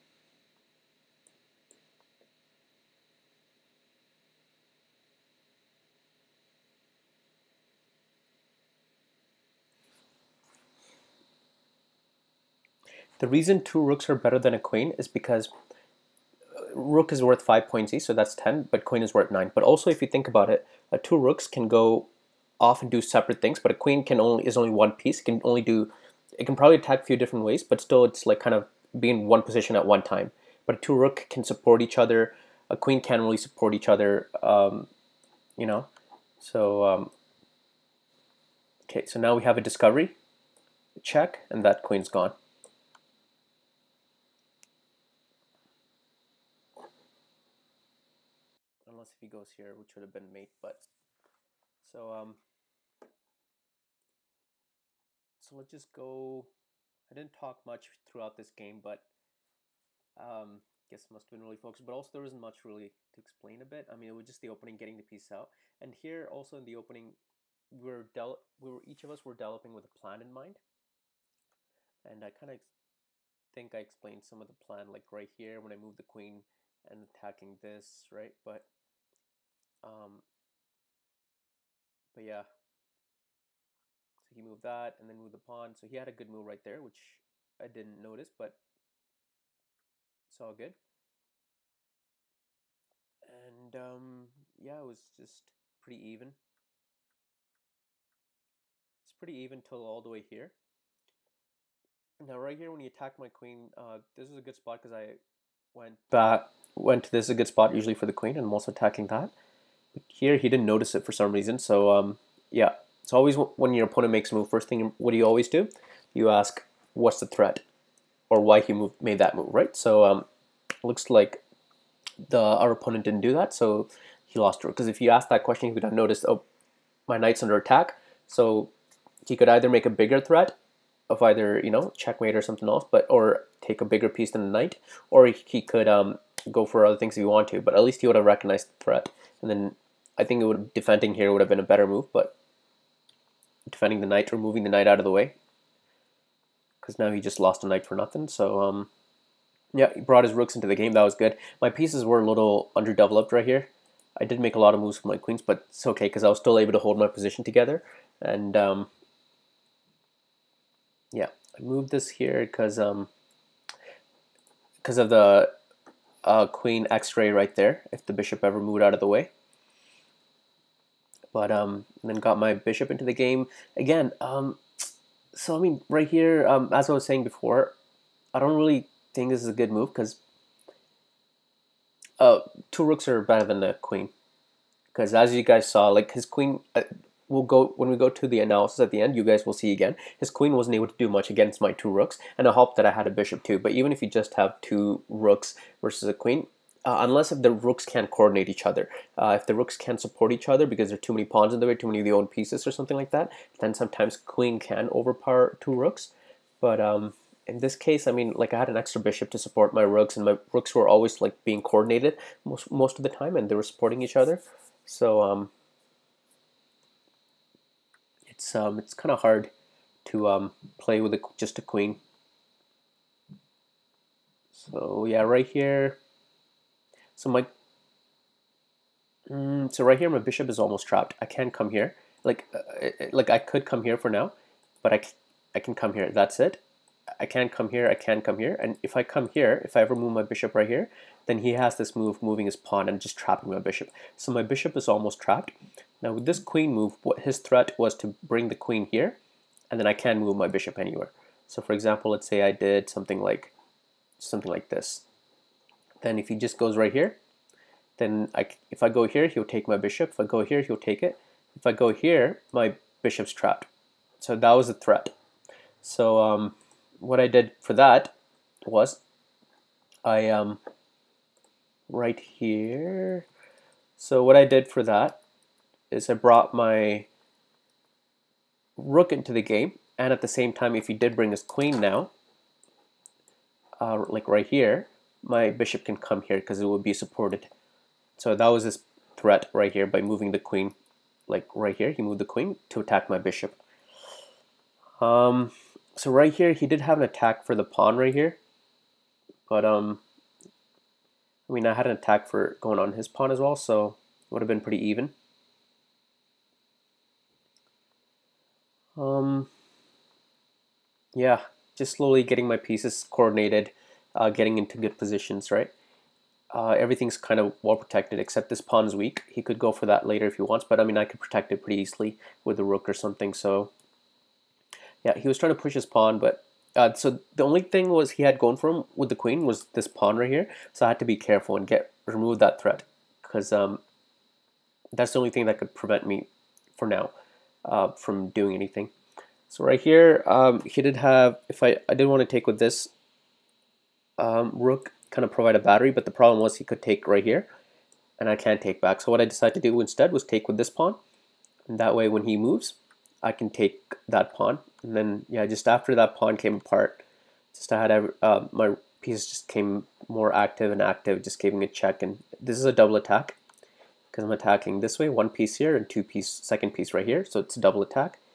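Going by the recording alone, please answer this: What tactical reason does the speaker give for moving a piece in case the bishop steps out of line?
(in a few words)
Queen x-ray.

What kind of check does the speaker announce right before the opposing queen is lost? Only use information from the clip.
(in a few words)
Discovery check.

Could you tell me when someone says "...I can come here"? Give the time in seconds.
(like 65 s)
235 s.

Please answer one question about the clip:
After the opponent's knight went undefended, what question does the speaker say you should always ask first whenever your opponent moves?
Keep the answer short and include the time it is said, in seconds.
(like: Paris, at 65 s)
What's the threat?, at 116 s.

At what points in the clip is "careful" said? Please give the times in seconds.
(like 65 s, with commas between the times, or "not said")
331 s.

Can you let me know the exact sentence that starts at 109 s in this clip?
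But here he didn't notice it for some reason.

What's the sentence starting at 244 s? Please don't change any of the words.
So my bishop is almost trapped.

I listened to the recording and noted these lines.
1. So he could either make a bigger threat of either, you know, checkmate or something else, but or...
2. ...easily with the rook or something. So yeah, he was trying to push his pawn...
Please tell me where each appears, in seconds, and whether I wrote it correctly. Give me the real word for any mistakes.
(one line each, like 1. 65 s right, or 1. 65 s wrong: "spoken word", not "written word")
1. 128 s right
2. 321 s right.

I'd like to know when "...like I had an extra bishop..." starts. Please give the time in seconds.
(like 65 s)
208 s.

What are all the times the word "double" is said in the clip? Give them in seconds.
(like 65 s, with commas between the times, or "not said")
362 s, 367 s.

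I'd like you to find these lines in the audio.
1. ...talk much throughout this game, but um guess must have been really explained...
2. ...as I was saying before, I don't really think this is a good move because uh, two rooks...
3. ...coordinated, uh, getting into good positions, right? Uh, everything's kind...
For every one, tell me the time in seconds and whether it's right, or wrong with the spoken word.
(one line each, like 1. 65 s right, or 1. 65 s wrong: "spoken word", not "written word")
1. 57 s wrong: "focused", not "explained"
2. 176 s right
3. 313 s right.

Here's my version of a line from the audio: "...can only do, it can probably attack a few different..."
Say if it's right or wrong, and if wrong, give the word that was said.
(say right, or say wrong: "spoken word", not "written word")
right.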